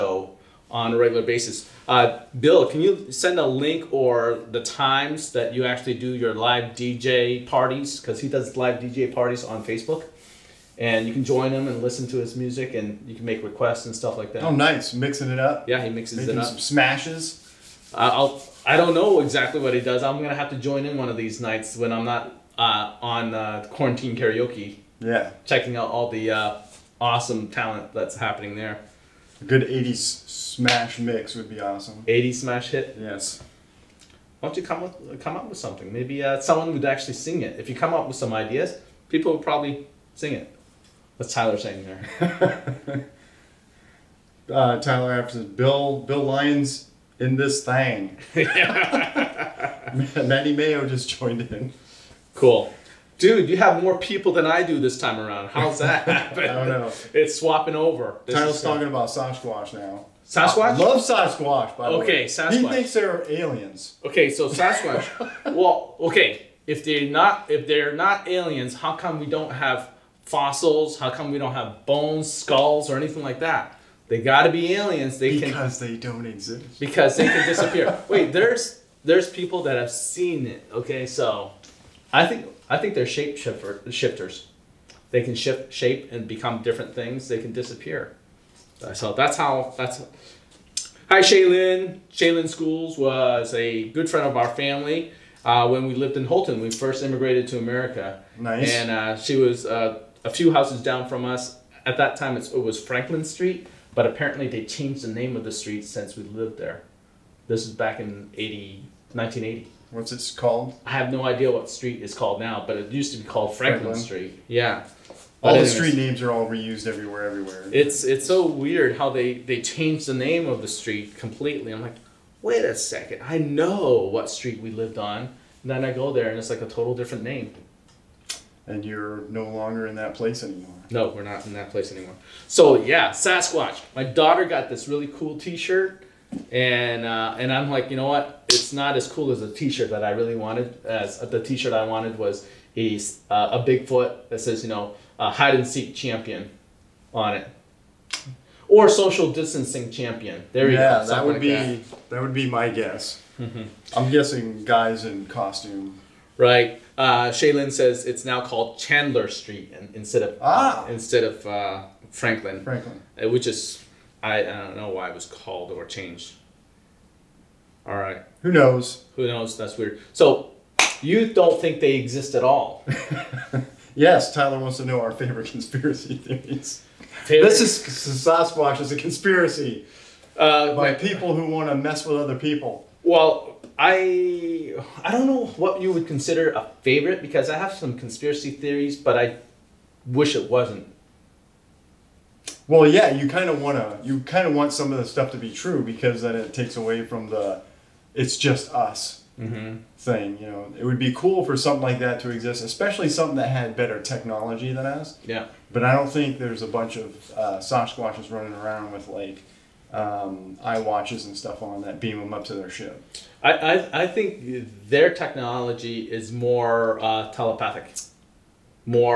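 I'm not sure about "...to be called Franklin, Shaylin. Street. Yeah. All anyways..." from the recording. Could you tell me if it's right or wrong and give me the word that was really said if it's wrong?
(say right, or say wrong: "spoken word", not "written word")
wrong: "Franklin", not "Shaylin".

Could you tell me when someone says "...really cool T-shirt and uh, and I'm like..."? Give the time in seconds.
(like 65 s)
134 s.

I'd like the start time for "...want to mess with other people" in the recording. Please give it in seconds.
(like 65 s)
181 s.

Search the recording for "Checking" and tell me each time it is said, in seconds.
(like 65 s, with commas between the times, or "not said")
25 s.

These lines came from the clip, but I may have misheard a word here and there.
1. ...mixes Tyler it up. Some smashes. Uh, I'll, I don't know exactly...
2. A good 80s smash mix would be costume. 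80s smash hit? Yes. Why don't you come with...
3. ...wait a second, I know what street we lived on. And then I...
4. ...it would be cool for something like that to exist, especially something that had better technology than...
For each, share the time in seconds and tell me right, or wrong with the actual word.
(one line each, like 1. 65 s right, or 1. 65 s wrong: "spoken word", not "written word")
1. 15 s wrong: "Making", not "Tyler"
2. 29 s wrong: "awesome", not "costume"
3. 122 s right
4. 200 s right.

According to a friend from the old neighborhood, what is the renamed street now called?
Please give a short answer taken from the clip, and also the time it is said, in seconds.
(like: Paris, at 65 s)
Chandler Street, at 158 s.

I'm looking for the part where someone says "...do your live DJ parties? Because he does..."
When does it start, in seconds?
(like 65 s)
5 s.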